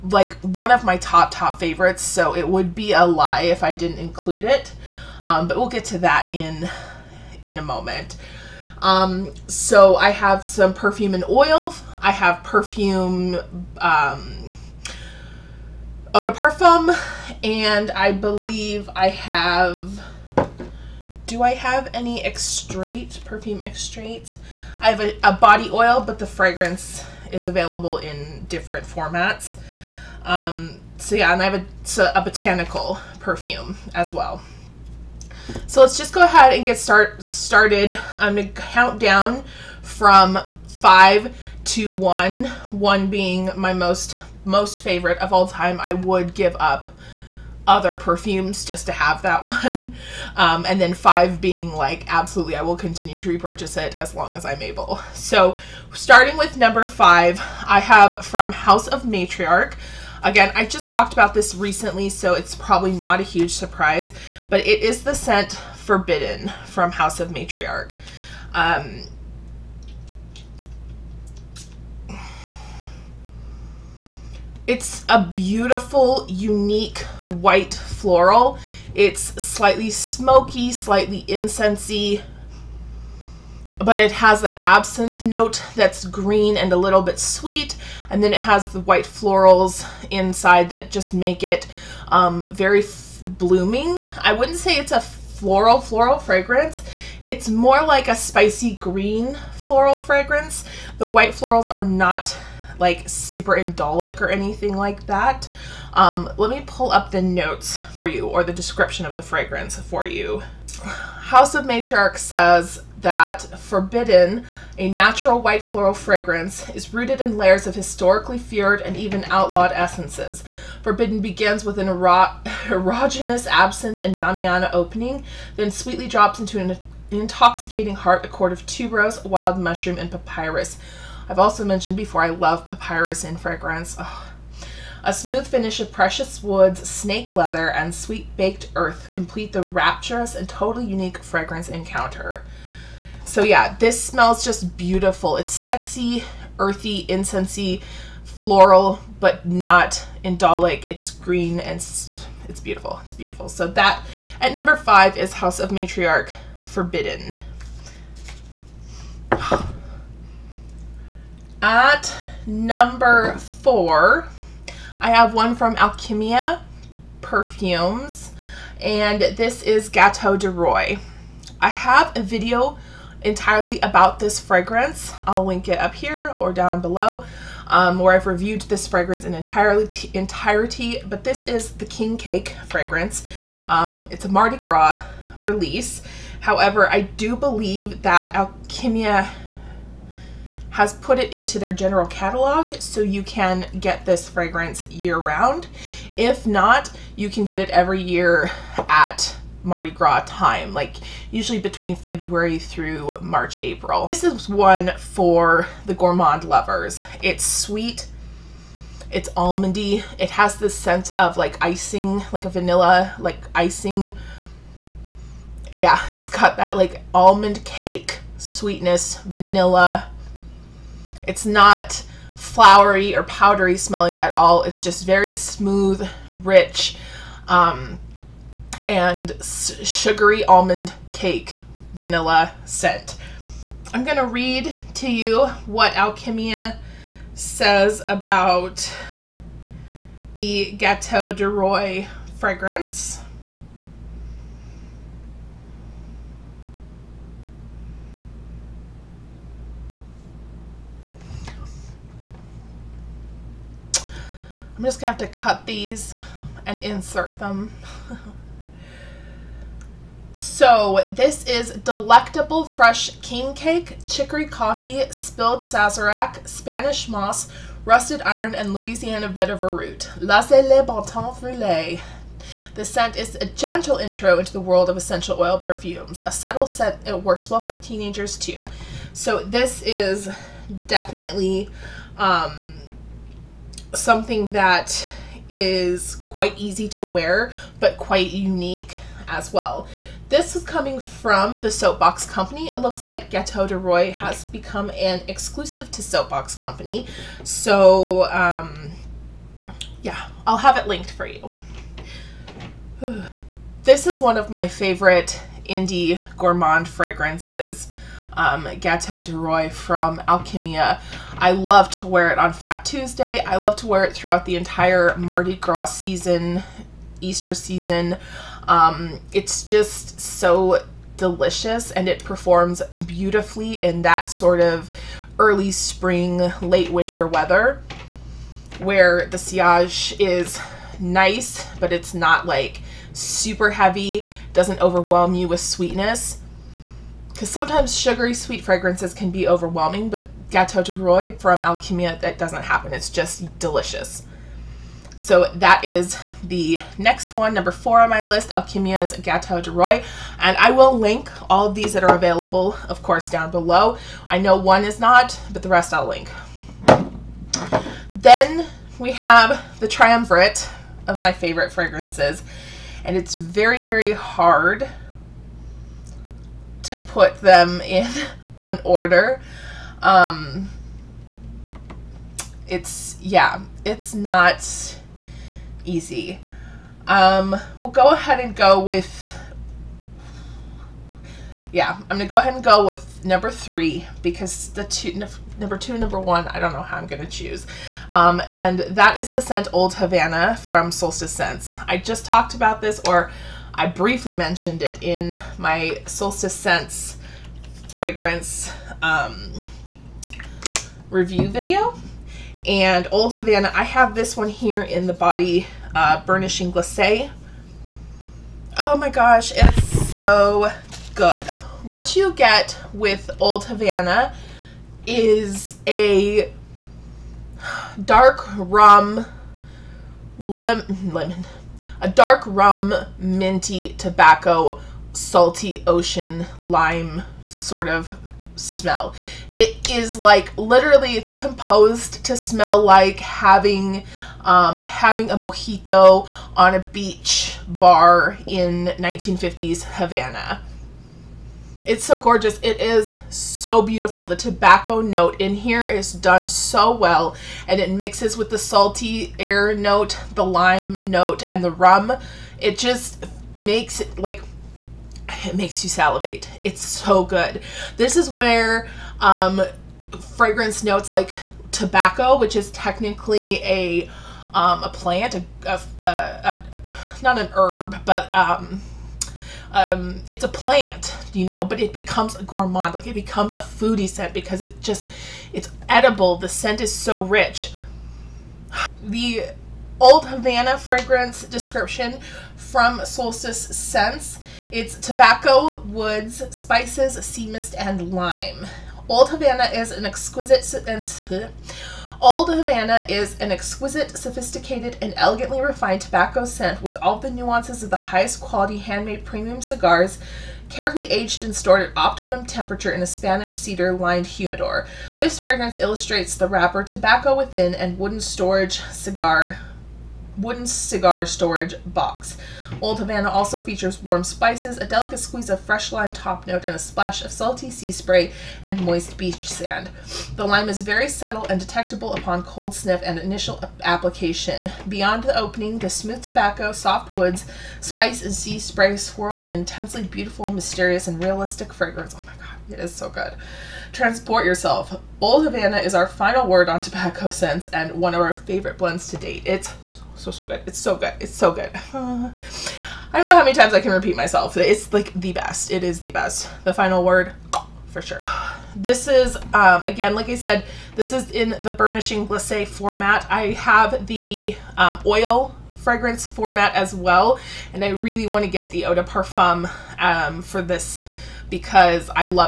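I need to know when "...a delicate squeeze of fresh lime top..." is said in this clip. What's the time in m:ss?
8:34.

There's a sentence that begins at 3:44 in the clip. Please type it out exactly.
It's just very smooth and rich um, and sugary almond cake vanilla scent.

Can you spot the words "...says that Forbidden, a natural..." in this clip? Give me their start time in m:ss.
1:52.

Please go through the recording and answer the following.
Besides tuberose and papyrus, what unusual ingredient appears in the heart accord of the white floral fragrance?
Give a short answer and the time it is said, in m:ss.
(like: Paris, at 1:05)
wild mushroom, at 2:09.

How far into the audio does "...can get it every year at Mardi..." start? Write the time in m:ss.
3:17.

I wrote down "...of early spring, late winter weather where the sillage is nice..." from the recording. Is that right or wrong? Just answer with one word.
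right.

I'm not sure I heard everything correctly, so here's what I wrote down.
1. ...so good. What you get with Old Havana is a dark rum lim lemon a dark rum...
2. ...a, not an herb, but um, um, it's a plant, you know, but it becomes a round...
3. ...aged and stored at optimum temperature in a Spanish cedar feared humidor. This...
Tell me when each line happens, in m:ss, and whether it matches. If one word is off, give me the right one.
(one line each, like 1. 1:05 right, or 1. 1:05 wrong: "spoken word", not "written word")
1. 6:50 right
2. 7:46 wrong: "gourmand", not "round"
3. 8:21 wrong: "lined", not "feared".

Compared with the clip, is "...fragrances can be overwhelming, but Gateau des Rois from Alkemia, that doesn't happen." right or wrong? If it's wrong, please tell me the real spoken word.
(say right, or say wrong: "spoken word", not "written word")
right.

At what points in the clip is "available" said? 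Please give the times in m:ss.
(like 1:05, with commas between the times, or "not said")
0:27, 5:52.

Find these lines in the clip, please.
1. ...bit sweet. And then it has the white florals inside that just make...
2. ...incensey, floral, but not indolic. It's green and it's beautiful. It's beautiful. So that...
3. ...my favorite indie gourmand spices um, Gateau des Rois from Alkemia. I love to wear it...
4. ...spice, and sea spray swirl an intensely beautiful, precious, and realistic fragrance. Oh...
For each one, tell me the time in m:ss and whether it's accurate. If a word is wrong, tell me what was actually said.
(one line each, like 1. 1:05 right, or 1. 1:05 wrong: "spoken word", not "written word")
1. 1:27 right
2. 2:27 right
3. 5:04 wrong: "fragrances", not "spices"
4. 8:47 wrong: "mysterious", not "precious".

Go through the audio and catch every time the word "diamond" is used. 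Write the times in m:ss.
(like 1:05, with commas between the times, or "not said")
not said.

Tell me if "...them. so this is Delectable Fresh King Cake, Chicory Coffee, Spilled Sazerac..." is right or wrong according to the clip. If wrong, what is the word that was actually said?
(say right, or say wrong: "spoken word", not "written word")
right.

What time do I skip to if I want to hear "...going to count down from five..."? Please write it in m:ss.
0:38.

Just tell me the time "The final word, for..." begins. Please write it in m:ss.
9:06.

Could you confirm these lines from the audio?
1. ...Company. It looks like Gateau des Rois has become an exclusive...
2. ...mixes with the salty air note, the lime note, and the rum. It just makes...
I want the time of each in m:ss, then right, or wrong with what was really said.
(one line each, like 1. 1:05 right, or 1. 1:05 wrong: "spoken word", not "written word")
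1. 4:52 right
2. 7:27 right.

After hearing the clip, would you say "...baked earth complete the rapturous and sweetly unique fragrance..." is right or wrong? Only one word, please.
wrong.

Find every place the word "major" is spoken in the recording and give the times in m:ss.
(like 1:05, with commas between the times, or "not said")
not said.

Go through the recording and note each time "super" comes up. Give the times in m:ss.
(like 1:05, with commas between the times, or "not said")
1:43, 5:33.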